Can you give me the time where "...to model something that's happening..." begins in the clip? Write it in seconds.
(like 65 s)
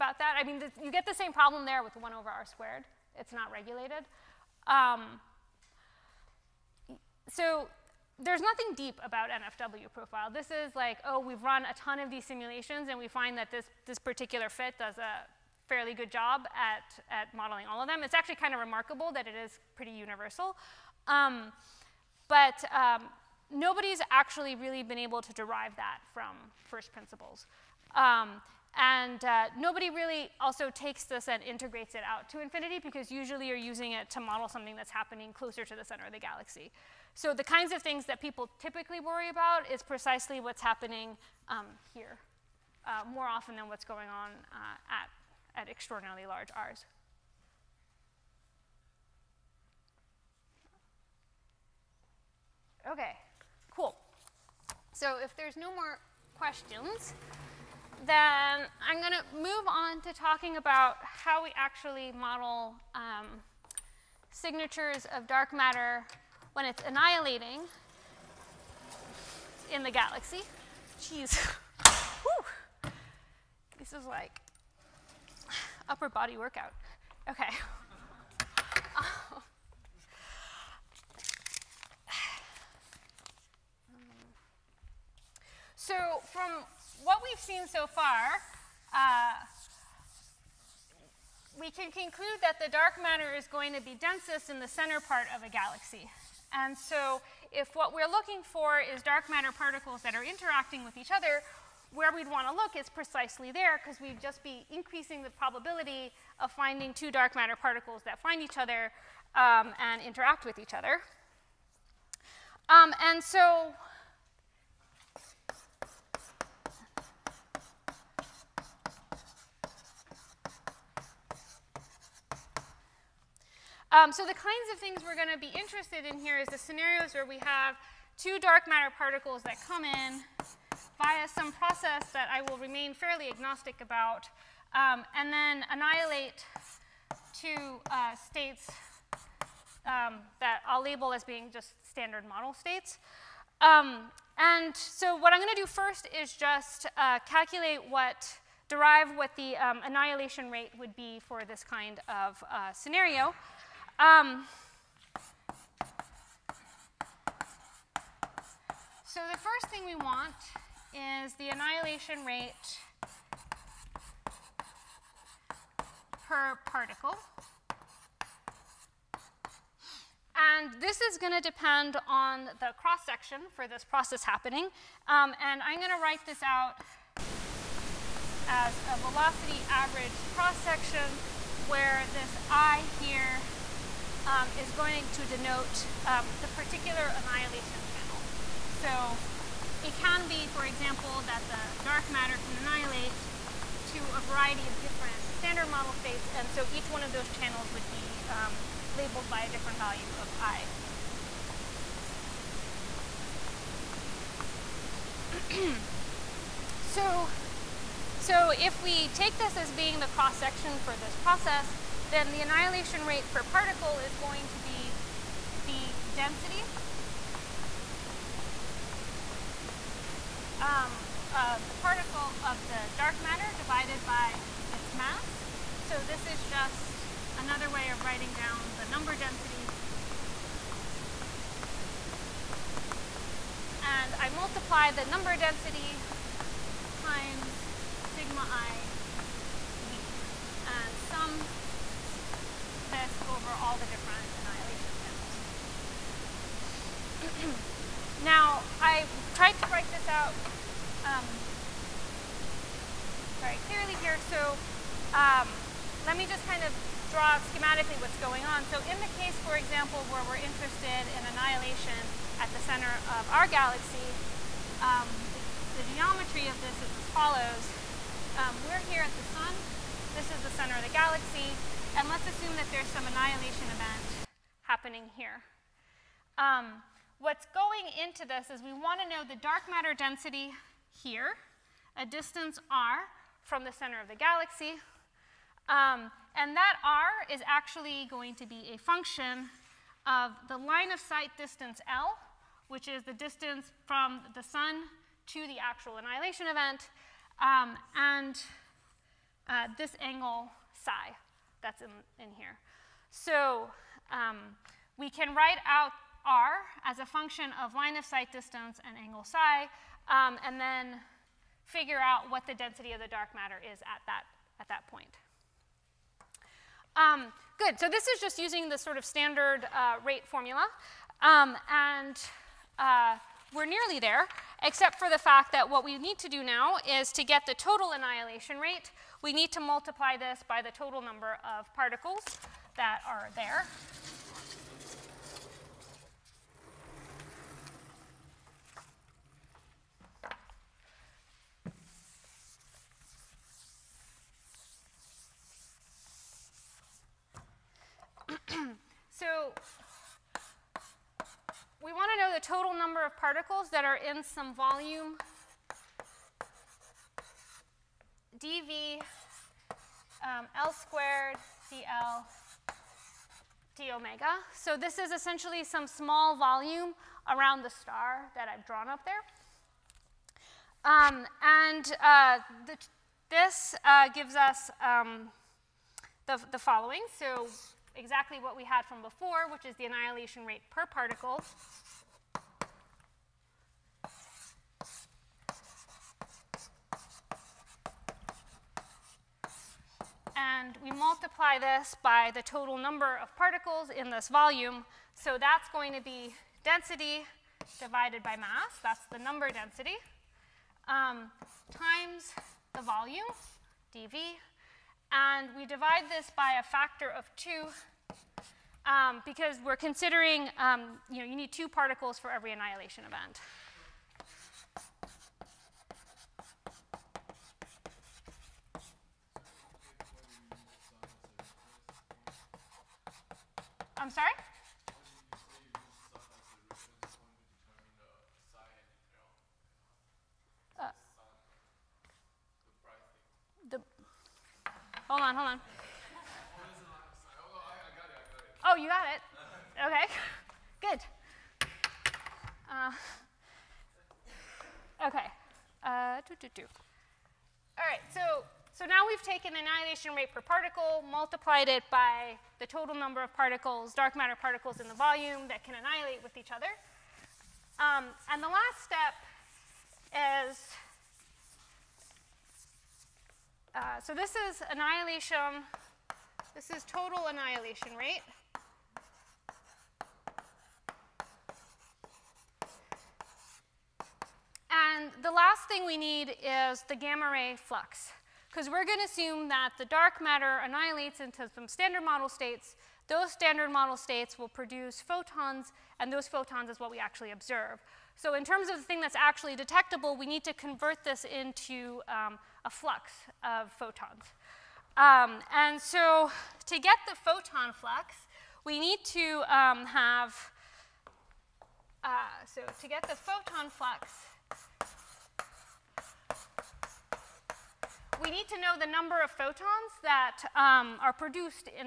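34 s.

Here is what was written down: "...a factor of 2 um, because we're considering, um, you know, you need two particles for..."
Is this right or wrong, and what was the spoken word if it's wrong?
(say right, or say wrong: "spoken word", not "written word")
right.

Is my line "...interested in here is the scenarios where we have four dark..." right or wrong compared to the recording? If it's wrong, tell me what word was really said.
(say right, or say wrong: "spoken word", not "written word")
wrong: "two", not "four".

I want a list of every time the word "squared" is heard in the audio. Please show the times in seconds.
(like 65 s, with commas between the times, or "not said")
2 s, 360 s.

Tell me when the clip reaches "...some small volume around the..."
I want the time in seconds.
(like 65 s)
365 s.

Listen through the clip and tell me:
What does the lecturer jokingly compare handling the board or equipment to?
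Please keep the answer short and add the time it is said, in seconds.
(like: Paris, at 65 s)
upper body workout, at 75 s.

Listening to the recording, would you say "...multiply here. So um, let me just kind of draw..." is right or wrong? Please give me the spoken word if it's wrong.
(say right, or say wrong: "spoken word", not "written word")
wrong: "clearly", not "multiply".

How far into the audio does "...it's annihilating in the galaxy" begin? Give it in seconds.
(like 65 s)
66 s.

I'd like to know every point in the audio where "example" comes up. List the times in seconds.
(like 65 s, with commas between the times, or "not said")
190 s, 259 s.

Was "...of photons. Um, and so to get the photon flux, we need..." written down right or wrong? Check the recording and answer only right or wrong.
right.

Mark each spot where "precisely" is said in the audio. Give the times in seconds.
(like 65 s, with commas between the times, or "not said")
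39 s, 102 s.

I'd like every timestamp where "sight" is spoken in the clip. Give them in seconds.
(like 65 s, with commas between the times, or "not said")
290 s, 308 s.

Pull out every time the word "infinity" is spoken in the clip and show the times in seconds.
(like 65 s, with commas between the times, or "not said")
32 s.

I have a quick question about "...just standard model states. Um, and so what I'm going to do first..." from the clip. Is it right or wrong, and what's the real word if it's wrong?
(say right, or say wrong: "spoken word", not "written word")
right.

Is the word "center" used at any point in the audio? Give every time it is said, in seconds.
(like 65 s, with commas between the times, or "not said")
35 s, 94 s, 262 s, 270 s, 283 s.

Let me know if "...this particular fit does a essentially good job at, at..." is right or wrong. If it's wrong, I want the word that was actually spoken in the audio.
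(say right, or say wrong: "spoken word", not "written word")
wrong: "fairly", not "essentially".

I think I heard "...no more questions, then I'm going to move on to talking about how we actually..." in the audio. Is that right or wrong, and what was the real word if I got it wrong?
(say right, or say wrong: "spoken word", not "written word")
right.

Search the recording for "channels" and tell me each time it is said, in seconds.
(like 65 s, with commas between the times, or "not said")
187 s, 197 s, 244 s.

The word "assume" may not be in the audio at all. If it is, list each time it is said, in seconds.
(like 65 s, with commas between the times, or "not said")
272 s, 479 s.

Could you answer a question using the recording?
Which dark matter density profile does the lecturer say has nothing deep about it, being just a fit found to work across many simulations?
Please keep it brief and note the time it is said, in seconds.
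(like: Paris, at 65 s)
NFW profile, at 9 s.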